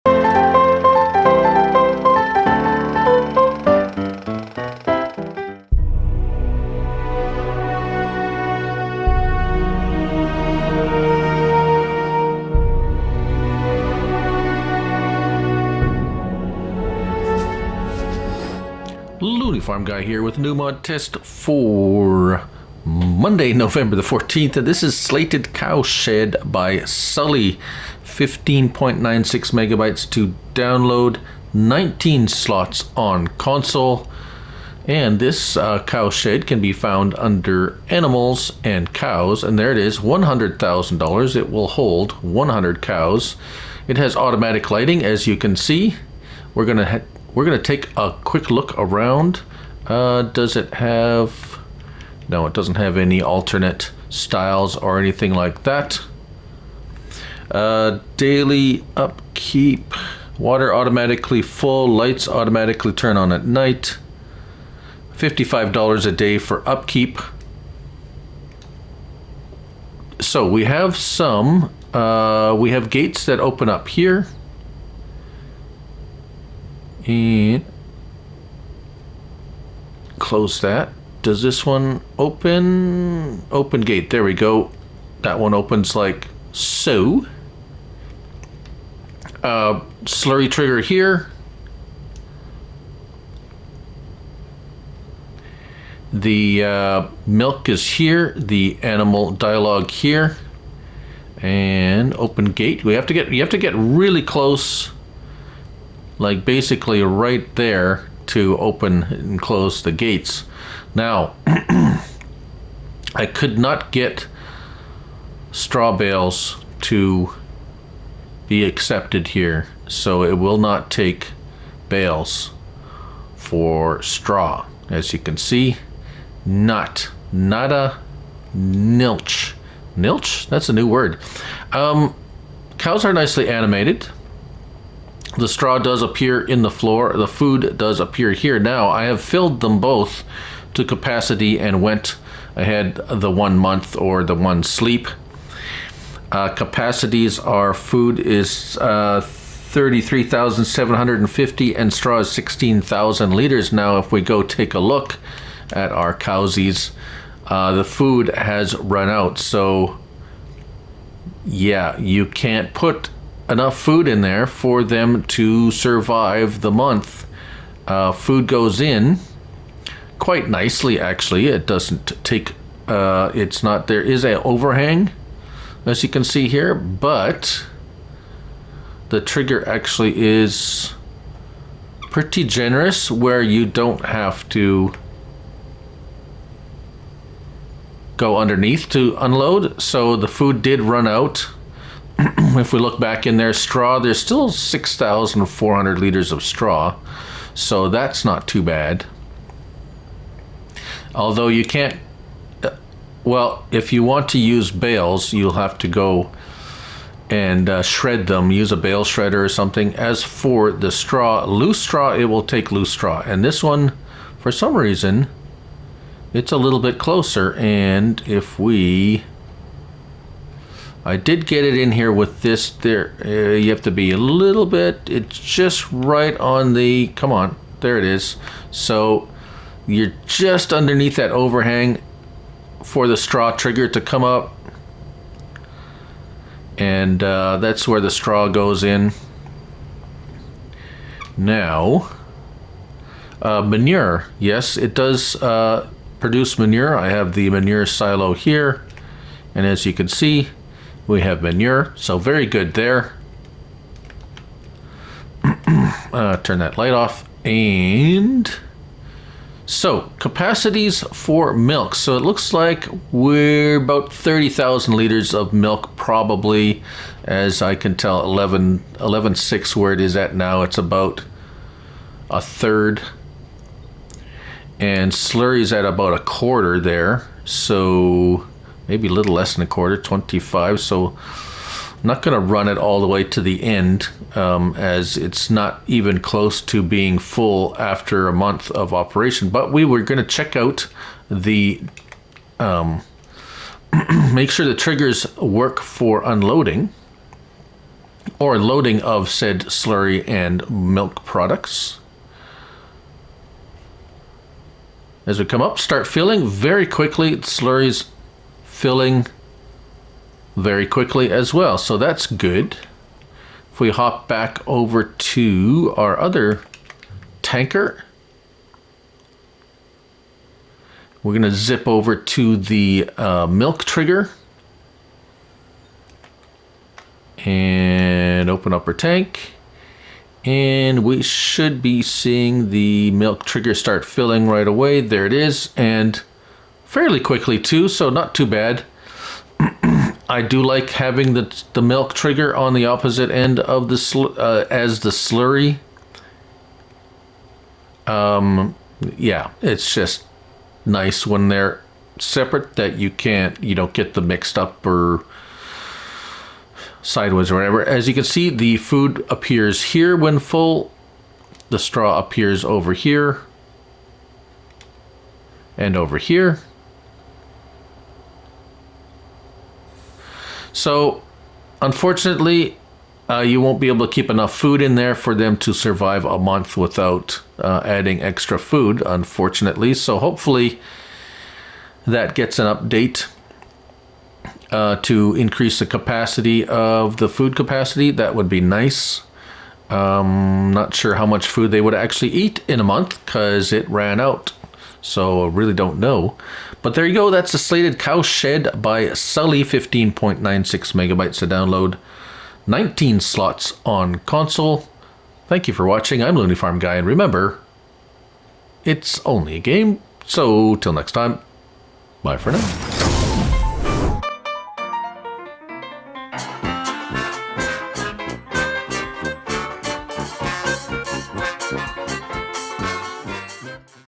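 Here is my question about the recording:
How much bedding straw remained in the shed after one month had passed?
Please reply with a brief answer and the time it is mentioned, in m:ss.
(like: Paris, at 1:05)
6,400 liters, at 3:14.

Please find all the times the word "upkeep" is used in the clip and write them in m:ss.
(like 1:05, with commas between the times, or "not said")
0:58, 1:06.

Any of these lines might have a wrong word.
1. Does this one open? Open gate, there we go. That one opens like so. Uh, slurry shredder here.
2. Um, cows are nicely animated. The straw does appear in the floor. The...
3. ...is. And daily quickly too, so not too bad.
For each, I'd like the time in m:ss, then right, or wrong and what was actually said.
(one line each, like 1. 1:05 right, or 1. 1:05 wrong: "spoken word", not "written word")
1. 1:21 wrong: "trigger", not "shredder"
2. 2:11 right
3. 5:35 wrong: "fairly", not "daily".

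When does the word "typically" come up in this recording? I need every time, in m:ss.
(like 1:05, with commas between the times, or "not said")
not said.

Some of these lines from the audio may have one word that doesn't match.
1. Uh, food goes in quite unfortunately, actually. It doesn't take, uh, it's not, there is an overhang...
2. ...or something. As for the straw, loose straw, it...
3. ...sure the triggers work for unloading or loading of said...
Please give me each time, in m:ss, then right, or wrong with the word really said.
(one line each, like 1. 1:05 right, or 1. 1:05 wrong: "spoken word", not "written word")
1. 2:47 wrong: "nicely", not "unfortunately"
2. 3:29 right
3. 4:54 right.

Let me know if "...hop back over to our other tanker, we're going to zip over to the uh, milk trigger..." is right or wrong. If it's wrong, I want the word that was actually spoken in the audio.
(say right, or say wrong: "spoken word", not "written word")
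right.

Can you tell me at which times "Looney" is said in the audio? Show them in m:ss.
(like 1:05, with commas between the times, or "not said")
0:19, 6:46.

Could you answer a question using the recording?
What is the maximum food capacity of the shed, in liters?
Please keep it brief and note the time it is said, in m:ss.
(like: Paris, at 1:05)
33,750, at 2:29.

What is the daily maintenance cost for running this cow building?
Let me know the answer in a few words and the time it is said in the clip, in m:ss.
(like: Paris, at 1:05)
$55, at 1:05.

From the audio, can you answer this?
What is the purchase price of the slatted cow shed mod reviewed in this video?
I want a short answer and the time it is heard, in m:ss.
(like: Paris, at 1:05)
$100,000, at 0:39.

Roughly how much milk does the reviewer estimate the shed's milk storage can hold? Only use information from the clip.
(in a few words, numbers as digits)
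30,000 liters.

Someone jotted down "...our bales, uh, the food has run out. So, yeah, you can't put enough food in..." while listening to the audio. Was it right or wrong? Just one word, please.
wrong.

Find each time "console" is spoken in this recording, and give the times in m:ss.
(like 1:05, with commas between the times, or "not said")
0:33, 6:44.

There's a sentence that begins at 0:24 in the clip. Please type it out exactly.
And this is Slatted Cow Shed by Sully.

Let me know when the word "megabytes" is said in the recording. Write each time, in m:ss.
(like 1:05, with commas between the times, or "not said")
0:29, 6:40.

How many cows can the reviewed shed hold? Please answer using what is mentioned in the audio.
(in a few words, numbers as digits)
100.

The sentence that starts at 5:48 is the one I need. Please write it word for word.
Um, yeah, it's just nice when they're separate that you can't you know get them mixed up or sideways or whatever.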